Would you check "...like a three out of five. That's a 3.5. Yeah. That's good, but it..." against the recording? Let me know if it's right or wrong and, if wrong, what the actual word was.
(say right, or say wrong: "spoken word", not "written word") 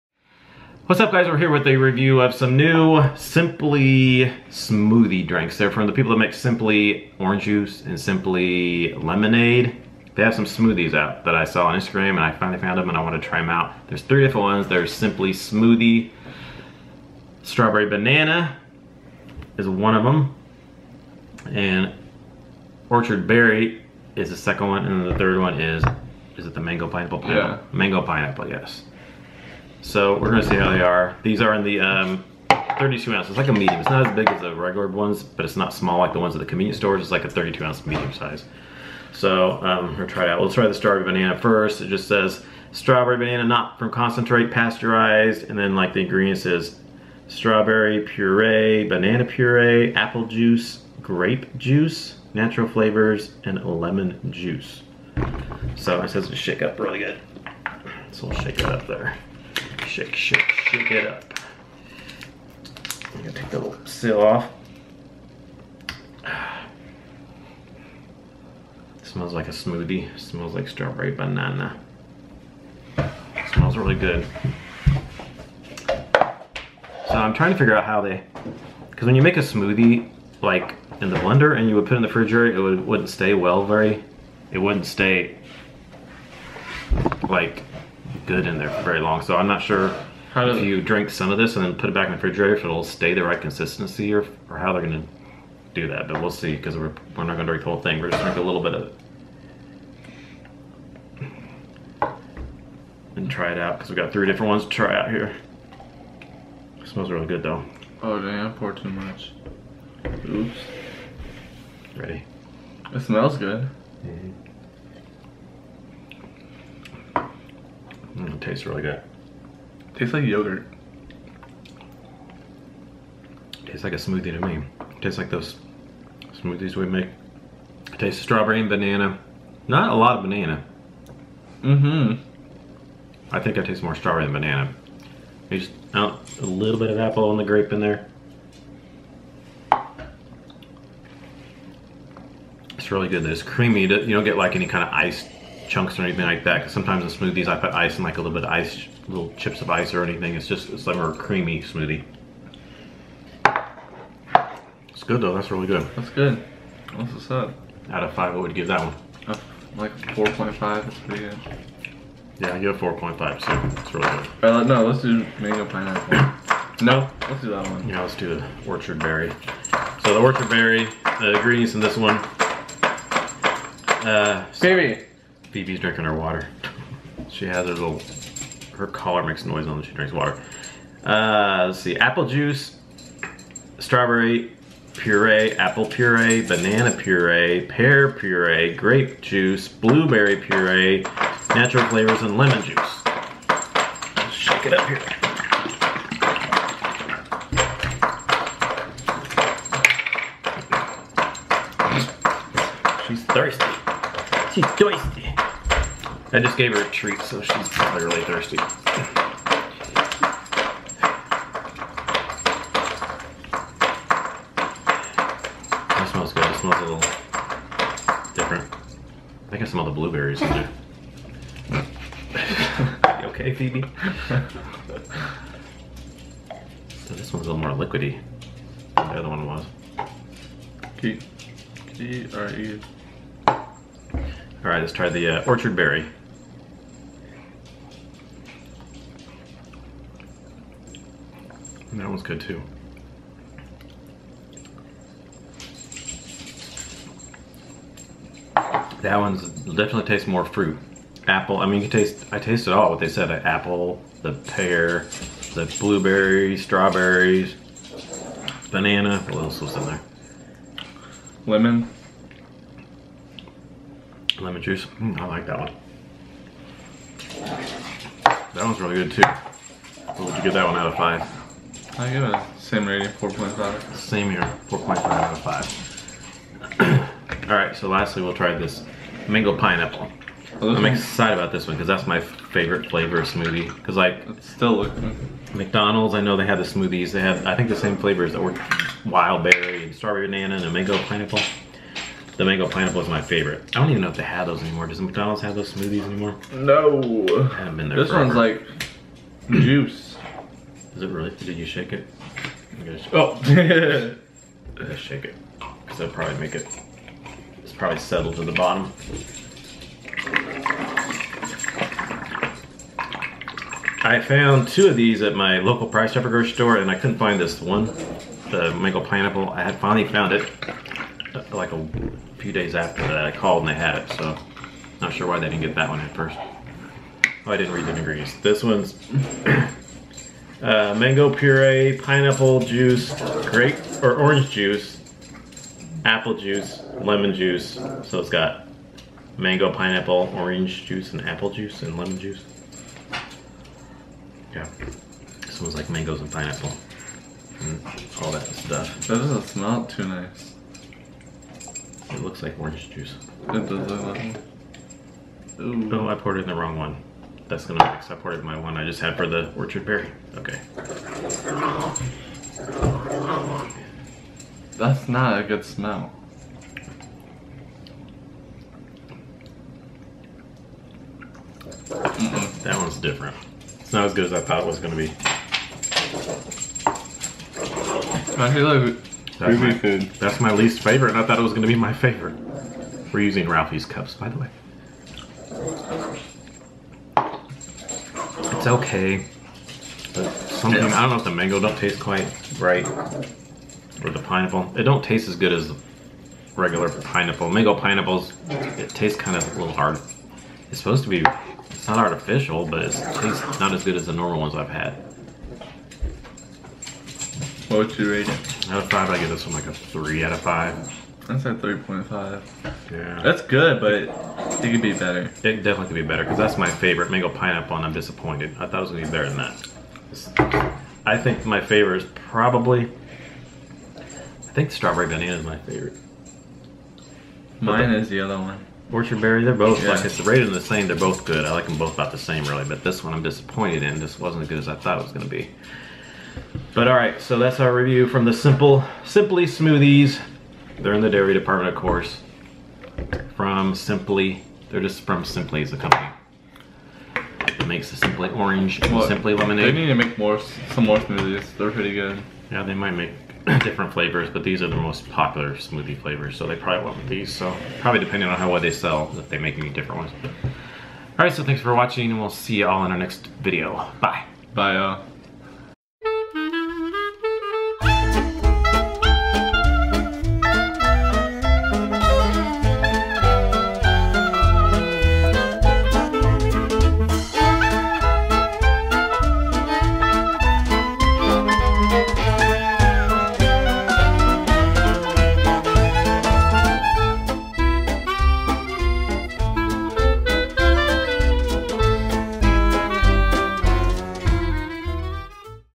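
right.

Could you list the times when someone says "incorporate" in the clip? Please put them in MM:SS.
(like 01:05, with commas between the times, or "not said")
not said.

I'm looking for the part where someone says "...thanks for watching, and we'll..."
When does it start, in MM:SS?
07:41.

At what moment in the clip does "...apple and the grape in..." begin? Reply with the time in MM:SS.
02:16.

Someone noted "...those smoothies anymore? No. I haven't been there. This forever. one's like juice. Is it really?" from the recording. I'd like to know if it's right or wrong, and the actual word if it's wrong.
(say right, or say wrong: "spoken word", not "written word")
right.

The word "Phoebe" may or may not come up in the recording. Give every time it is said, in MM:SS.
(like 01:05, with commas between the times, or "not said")
02:55, 03:43.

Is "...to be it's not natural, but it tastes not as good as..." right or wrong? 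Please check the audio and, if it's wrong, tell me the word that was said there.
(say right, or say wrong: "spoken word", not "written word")
wrong: "artificial", not "natural".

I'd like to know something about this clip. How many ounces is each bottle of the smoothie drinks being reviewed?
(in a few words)
32.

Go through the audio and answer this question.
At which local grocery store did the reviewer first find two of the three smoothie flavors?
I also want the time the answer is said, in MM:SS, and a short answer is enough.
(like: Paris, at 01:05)
Price Chopper, at 05:15.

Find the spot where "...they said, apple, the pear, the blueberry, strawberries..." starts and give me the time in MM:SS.
04:12.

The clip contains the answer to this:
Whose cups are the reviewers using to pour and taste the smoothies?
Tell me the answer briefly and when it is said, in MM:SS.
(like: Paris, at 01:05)
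Ralphie's, at 06:23.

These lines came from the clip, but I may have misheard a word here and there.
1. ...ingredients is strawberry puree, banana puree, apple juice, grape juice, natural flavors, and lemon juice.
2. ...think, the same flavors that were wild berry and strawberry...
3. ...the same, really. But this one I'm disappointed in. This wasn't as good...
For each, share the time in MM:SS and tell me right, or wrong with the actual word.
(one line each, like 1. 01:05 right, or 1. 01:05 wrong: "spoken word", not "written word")
1. 00:46 right
2. 04:47 right
3. 07:12 right.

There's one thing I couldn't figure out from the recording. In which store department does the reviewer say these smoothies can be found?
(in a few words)
dairy department.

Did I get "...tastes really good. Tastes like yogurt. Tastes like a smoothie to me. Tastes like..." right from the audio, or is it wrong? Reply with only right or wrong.
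right.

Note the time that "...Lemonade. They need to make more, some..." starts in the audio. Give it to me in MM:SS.
07:29.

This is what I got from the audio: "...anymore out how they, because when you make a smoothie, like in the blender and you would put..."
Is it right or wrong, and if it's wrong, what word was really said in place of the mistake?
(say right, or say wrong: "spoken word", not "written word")
wrong: "figure", not "anymore".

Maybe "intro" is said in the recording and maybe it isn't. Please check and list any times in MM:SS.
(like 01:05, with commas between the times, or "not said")
not said.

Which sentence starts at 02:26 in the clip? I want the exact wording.
Because sometimes in smoothies I put ice and like a little bit of ice, little chips of ice or anything.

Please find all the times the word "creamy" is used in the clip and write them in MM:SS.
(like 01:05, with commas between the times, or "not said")
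02:23, 02:31.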